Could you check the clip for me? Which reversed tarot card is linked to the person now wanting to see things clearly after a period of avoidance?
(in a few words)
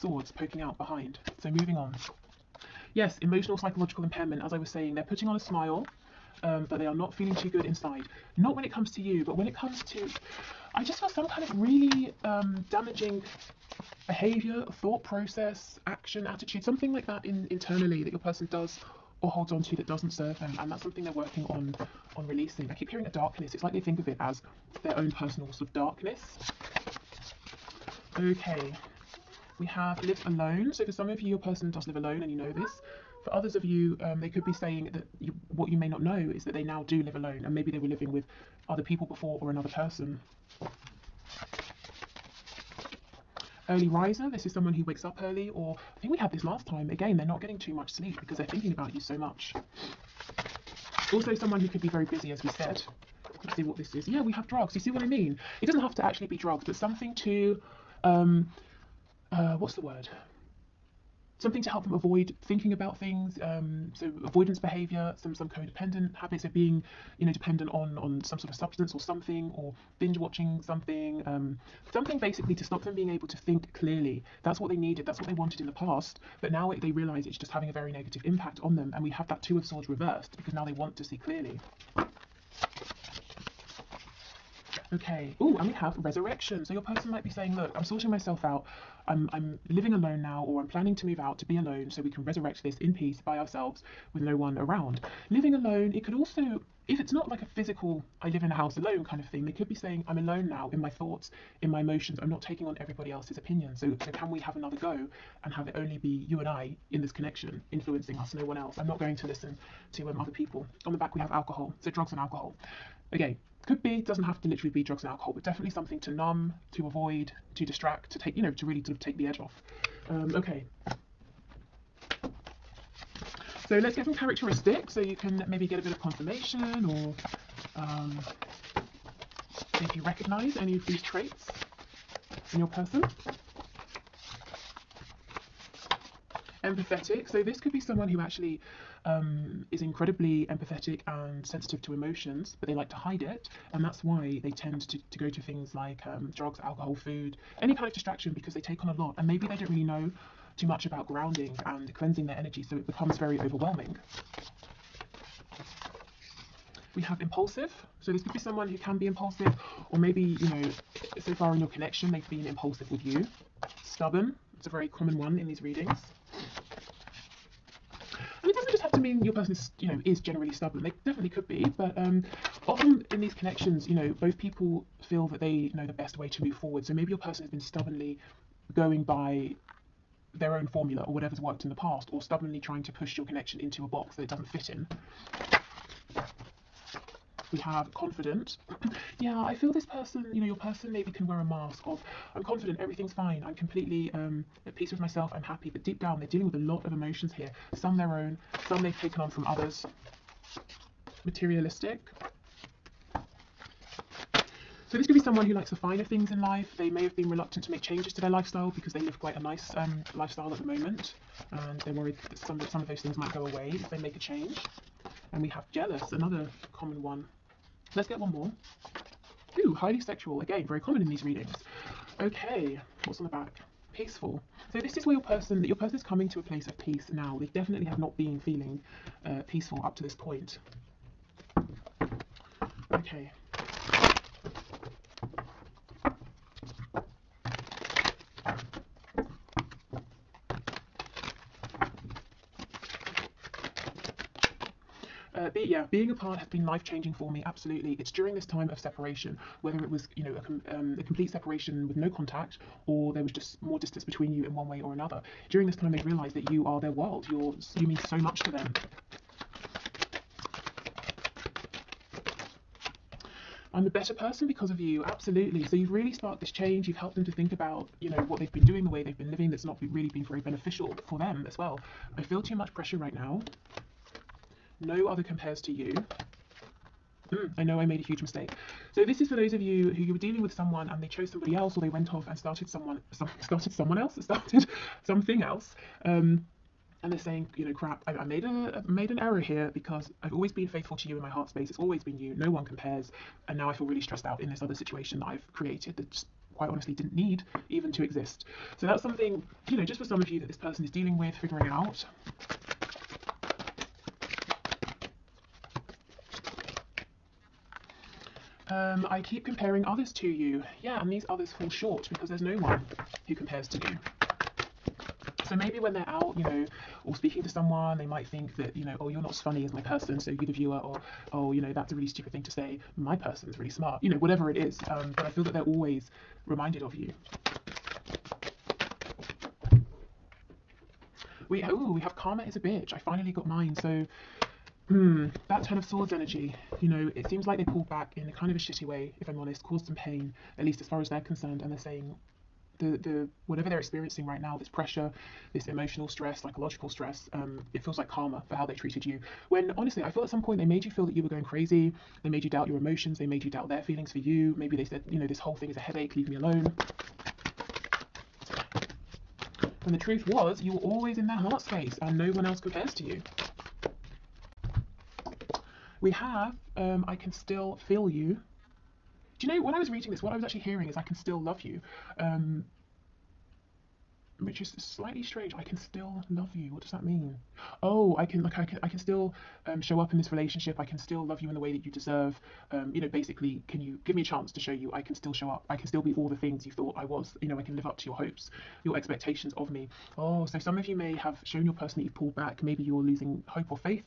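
Two of Swords.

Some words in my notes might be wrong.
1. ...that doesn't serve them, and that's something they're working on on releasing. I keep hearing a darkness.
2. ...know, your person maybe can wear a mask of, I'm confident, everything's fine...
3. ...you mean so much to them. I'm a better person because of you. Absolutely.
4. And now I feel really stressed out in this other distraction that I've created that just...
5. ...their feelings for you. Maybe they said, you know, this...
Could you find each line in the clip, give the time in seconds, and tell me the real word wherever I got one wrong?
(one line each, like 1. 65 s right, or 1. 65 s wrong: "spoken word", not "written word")
1. 19 s right
2. 190 s right
3. 257 s right
4. 293 s wrong: "situation", not "distraction"
5. 353 s right.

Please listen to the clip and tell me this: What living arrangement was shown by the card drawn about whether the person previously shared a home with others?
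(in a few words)
Lives alone.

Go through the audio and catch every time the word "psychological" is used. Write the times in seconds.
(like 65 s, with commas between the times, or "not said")
3 s, 346 s.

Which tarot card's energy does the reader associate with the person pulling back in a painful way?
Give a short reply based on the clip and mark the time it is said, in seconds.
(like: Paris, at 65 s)
Ten of Swords, at 335 s.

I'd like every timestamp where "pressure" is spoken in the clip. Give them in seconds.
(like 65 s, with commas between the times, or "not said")
272 s, 344 s.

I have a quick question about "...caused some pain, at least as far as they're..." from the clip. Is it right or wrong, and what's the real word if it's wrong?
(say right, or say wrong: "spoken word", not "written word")
right.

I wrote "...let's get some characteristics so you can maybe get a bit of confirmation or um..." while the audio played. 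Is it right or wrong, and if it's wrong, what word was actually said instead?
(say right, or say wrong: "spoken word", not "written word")
right.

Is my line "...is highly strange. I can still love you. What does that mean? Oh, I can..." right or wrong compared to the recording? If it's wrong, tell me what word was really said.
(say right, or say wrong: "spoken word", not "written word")
wrong: "slightly", not "highly".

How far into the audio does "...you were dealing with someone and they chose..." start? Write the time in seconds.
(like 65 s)
280 s.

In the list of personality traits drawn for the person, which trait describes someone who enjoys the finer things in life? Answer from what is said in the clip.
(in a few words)
Materialistic.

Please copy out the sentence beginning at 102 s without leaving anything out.
I'm not taking on everybody else's opinion.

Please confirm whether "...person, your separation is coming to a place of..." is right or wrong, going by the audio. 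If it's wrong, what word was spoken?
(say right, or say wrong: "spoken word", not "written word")
wrong: "person", not "separation".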